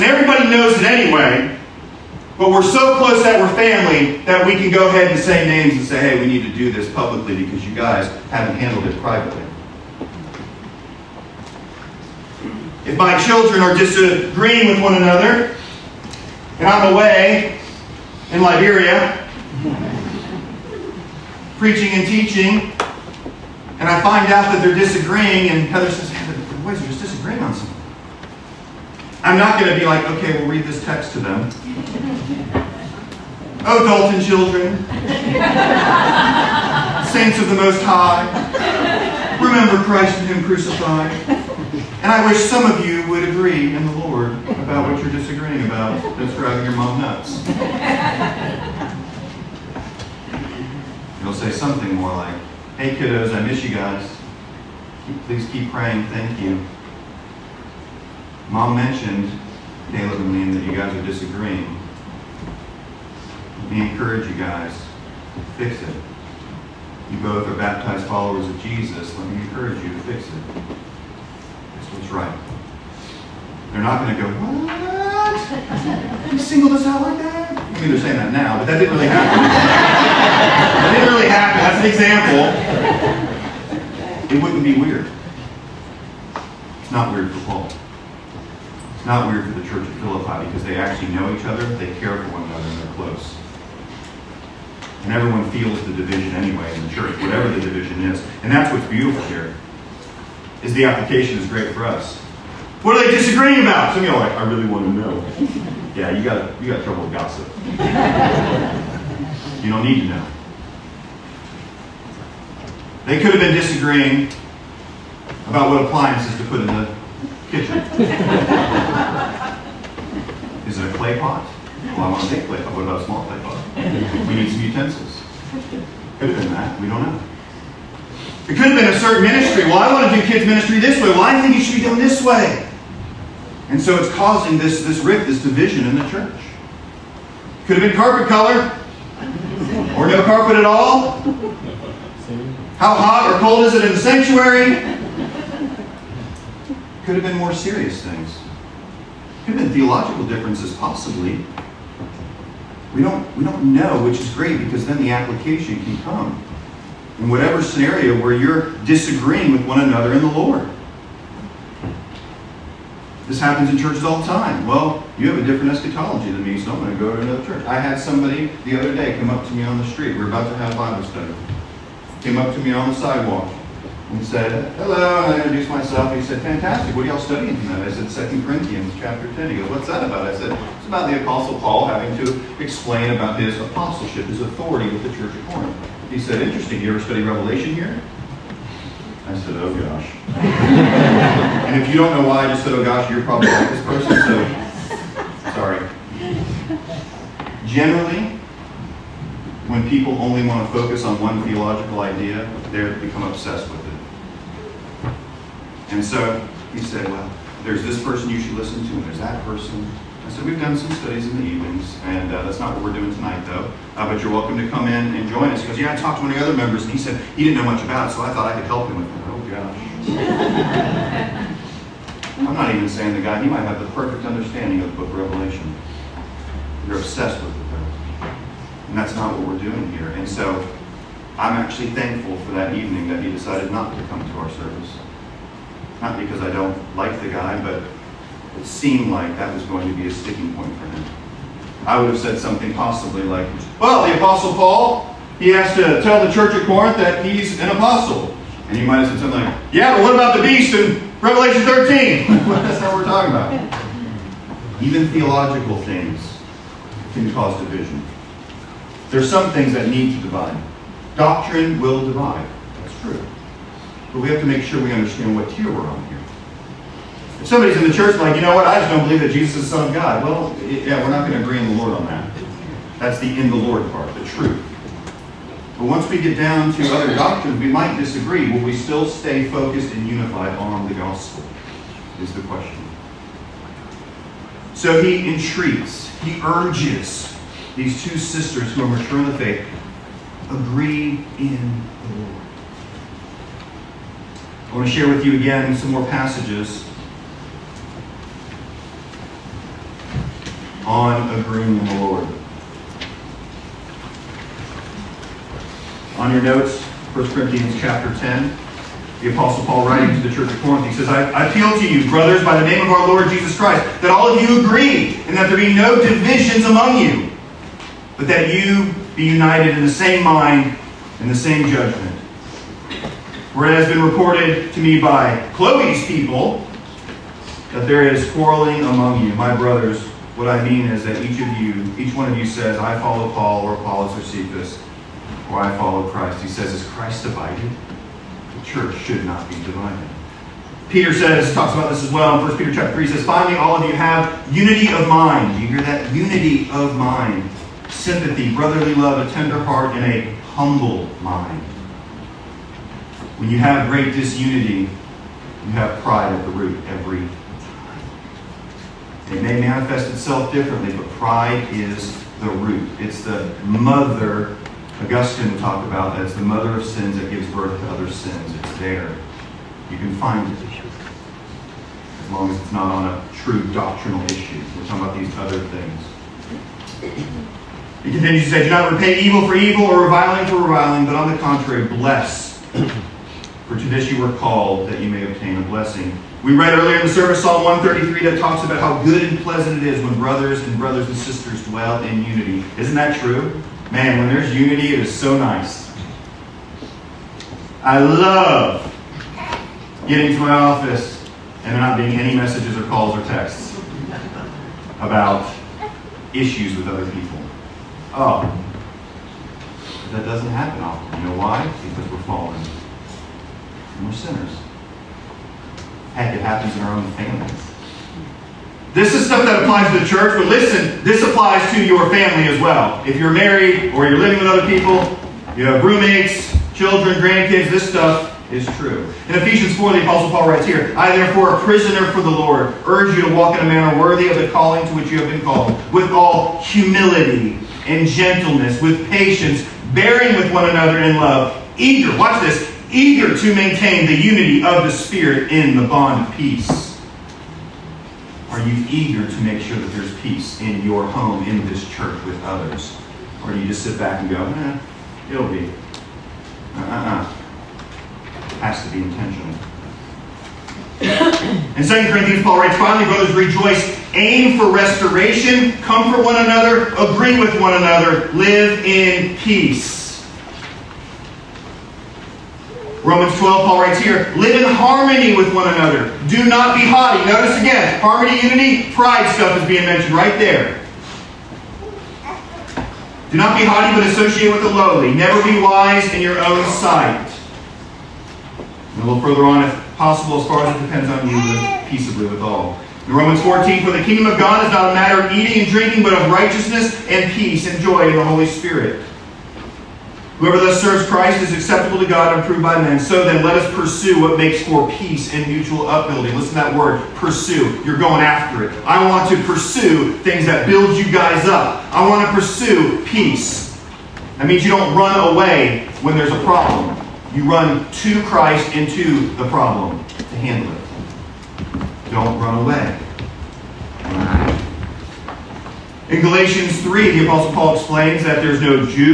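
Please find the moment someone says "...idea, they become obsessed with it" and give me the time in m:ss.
3:22.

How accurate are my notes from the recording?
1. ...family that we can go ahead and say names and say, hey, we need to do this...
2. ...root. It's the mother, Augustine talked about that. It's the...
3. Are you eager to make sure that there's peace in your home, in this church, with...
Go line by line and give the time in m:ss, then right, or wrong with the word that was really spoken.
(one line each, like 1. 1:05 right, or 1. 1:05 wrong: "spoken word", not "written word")
1. 0:03 right
2. 6:02 right
3. 7:28 right.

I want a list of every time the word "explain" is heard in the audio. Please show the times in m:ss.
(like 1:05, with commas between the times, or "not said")
3:02, 8:47.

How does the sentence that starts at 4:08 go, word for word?
And he might have said something like, yeah, but what about the beast in Revelation 13?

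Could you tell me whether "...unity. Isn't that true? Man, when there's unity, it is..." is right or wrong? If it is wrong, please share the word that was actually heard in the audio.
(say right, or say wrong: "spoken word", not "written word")
right.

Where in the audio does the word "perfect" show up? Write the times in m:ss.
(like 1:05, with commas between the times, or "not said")
3:43.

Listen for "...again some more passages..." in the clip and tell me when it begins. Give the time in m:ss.
4:55.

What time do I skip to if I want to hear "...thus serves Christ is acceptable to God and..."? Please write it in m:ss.
8:20.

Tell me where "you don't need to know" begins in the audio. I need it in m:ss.
1:49.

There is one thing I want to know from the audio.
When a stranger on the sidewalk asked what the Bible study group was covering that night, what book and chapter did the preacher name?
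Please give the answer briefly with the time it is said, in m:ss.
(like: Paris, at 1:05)
2 Corinthians 10, at 2:58.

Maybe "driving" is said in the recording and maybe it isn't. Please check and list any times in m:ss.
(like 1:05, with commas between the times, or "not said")
0:46.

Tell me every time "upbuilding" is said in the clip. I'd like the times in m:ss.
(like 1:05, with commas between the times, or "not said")
8:25.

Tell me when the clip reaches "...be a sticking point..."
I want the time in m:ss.
3:59.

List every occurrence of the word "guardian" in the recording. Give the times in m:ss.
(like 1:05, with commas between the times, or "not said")
not said.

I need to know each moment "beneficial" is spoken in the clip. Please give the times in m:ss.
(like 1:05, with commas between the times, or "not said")
not said.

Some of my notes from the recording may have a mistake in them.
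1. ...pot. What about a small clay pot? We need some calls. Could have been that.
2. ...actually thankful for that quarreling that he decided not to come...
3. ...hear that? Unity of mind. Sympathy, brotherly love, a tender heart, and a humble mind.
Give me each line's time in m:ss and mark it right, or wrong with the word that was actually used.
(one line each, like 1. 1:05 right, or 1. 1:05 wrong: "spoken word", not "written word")
1. 2:02 wrong: "utensils", not "calls"
2. 3:51 wrong: "evening", not "quarreling"
3. 5:45 right.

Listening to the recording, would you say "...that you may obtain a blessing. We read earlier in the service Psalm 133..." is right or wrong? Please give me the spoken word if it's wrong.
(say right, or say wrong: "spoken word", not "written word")
right.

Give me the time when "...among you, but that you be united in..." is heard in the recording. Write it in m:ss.
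5:16.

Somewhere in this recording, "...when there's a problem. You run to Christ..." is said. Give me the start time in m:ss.
8:36.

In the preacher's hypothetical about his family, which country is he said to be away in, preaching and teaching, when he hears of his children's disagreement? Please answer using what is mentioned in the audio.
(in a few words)
Liberia.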